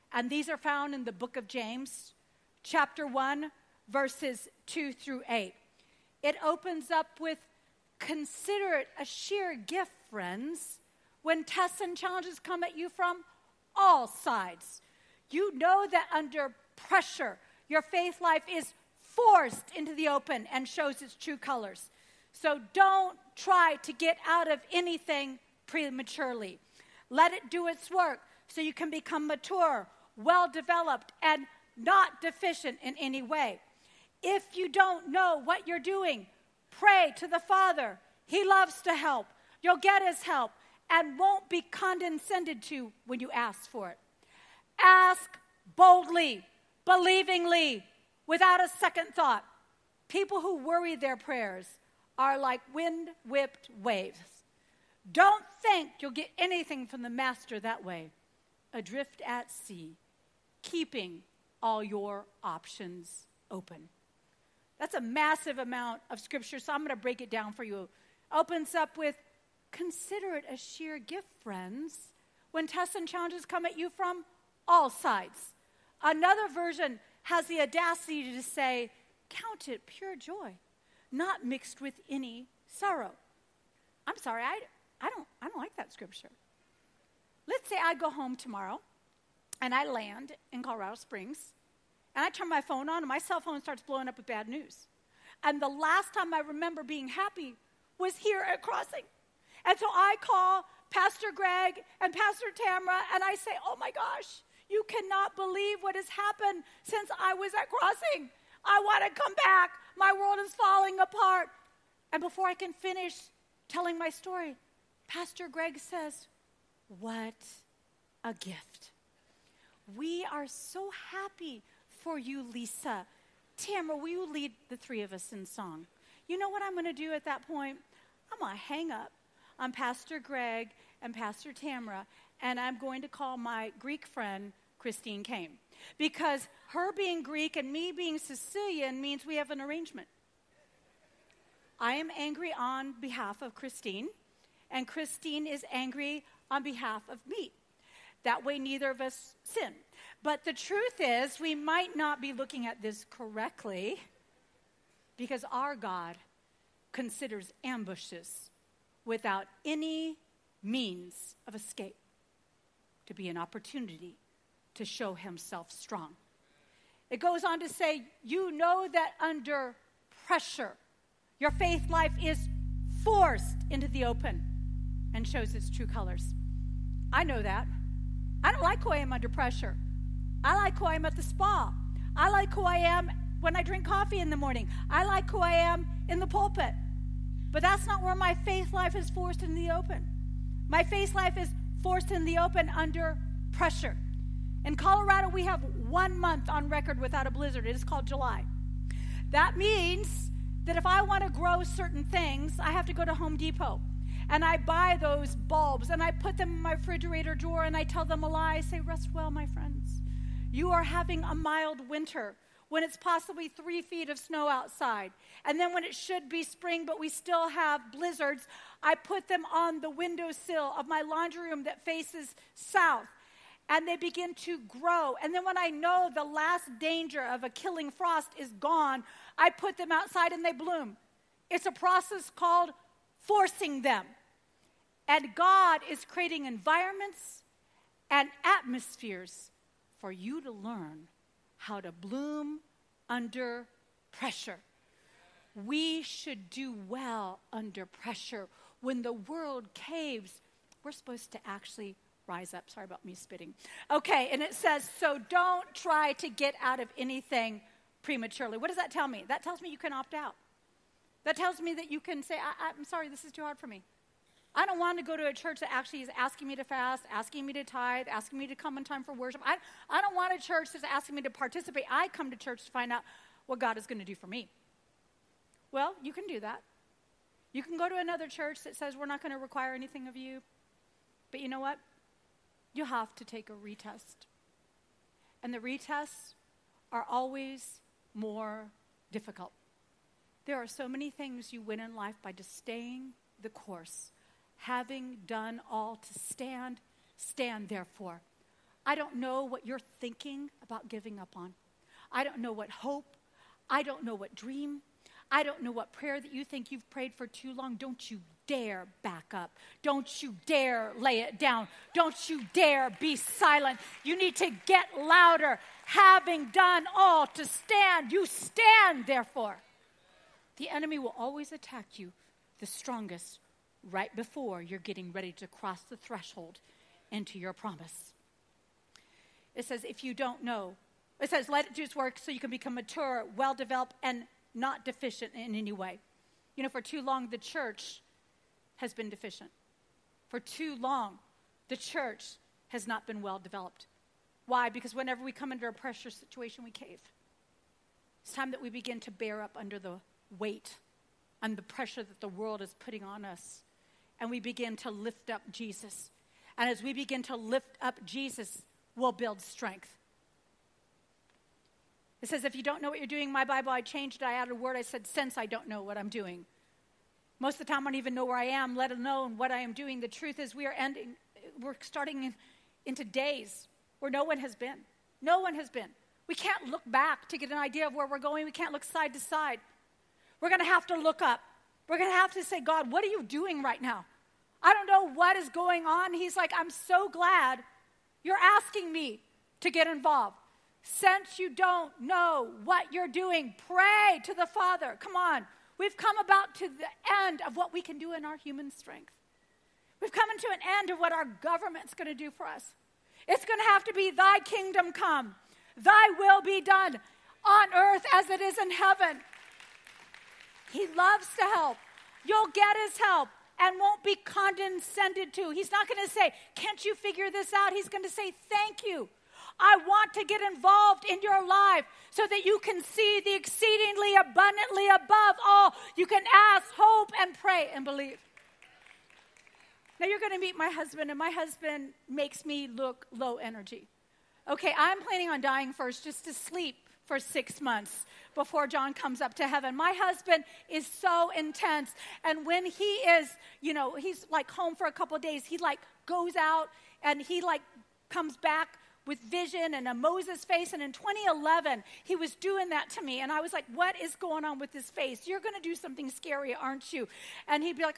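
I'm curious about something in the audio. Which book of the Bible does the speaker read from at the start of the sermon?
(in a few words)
James.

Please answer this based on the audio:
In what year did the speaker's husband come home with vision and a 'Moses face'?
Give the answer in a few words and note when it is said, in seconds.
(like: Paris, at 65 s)
2011, at 450 s.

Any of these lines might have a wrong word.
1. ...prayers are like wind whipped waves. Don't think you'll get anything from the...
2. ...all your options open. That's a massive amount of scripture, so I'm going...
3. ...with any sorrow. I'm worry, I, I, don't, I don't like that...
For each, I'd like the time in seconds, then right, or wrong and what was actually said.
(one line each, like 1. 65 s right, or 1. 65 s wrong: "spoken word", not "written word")
1. 51 s right
2. 61 s right
3. 81 s wrong: "sorry", not "worry".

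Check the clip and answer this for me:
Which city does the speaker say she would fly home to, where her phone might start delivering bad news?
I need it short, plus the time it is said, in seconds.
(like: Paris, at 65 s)
Colorado Springs, at 90 s.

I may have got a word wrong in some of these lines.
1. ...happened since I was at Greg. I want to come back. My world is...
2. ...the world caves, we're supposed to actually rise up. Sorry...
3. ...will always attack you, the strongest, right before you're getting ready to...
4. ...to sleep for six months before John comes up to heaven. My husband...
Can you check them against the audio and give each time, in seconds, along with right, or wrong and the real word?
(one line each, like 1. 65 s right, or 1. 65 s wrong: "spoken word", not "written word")
1. 106 s wrong: "Crossing", not "Greg"
2. 249 s right
3. 320 s right
4. 436 s right.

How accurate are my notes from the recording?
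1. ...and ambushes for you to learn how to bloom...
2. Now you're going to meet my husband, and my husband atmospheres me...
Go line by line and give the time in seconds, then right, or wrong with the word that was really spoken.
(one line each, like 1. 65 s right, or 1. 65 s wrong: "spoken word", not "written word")
1. 238 s wrong: "atmospheres", not "ambushes"
2. 429 s wrong: "makes", not "atmospheres".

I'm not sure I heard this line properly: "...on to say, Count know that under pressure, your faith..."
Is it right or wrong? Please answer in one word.
wrong.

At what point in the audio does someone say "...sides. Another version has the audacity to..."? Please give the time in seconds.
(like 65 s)
74 s.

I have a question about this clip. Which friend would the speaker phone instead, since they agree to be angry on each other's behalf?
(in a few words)
Christine Caine.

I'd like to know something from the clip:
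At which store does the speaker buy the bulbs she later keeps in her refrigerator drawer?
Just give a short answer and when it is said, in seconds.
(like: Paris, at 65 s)
Home Depot, at 203 s.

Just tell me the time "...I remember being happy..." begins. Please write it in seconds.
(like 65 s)
96 s.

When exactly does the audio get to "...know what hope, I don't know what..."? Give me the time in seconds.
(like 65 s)
302 s.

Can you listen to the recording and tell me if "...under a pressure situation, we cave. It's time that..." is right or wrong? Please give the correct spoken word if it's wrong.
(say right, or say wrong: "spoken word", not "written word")
right.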